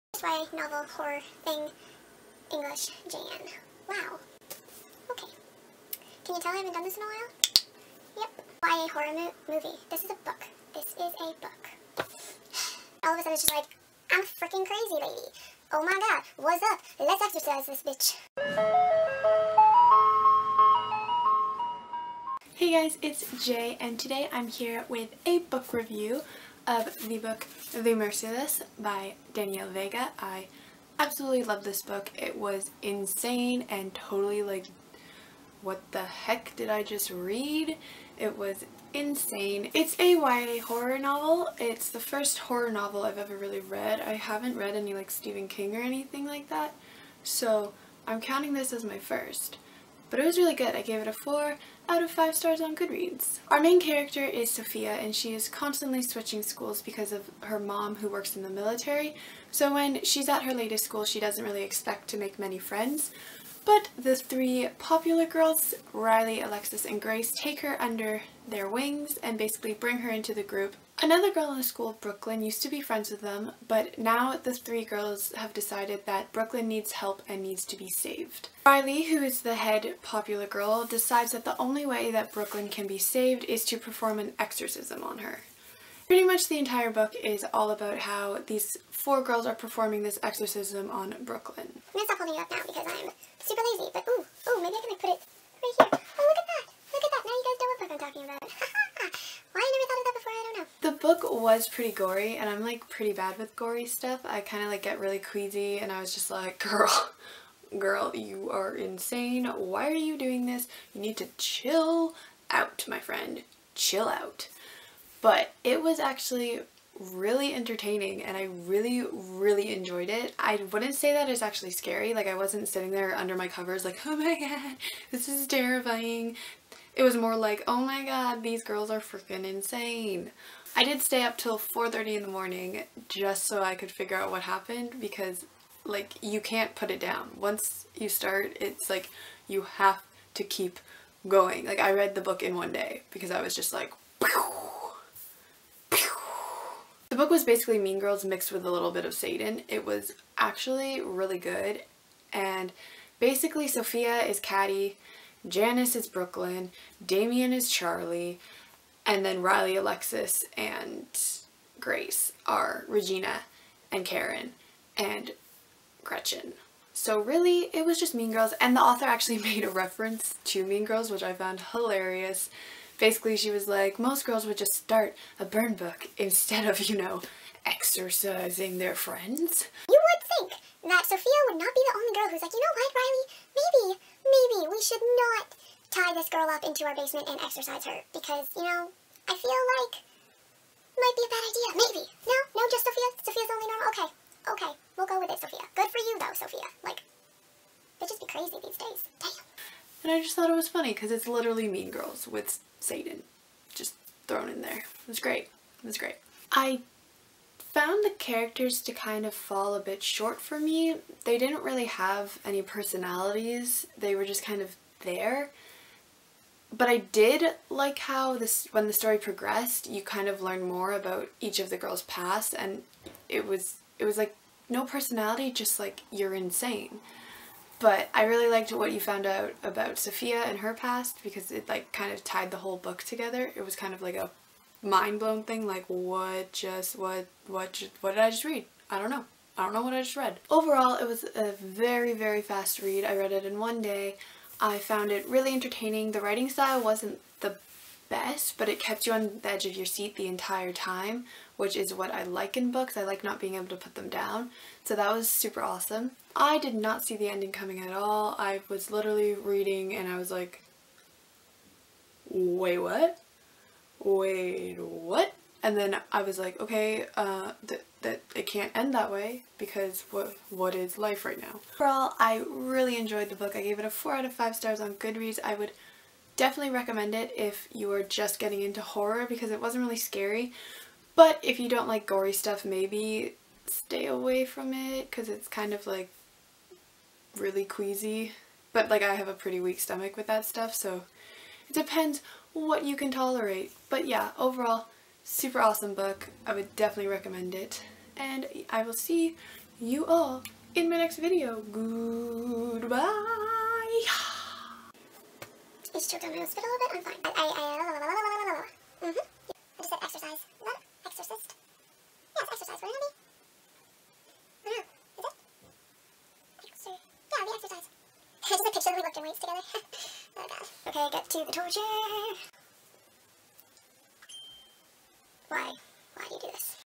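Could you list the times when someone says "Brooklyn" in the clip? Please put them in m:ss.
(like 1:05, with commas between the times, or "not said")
1:11, 1:16, 1:22, 1:31, 2:36.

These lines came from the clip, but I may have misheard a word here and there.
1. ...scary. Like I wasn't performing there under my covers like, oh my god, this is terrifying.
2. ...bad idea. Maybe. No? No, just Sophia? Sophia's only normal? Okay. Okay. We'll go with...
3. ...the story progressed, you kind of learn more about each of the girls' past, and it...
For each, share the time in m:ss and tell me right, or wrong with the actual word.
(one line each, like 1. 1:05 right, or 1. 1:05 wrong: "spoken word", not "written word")
1. 2:01 wrong: "sitting", not "performing"
2. 3:11 right
3. 3:38 right.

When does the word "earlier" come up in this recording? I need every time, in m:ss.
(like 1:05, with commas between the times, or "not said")
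not said.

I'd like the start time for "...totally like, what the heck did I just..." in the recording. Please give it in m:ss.
0:33.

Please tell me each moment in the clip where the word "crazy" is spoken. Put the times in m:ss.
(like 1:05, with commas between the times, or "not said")
0:14, 3:18.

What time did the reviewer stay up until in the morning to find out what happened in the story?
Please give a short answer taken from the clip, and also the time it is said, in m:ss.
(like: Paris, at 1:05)
4:30, at 2:11.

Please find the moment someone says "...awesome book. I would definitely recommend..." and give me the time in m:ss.
4:55.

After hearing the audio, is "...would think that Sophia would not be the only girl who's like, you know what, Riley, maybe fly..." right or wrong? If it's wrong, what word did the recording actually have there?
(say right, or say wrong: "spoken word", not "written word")
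right.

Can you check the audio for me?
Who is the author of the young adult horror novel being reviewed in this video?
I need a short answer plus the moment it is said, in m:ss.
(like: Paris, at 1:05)
Danielle Vega, at 0:29.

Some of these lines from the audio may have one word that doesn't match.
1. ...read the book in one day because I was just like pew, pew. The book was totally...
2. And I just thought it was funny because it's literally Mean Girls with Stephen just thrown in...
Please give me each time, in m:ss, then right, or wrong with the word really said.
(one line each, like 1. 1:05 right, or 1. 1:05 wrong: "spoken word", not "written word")
1. 2:21 wrong: "basically", not "totally"
2. 3:20 wrong: "Satan", not "Stephen".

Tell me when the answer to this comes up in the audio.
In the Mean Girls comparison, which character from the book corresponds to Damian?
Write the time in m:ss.
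2:37.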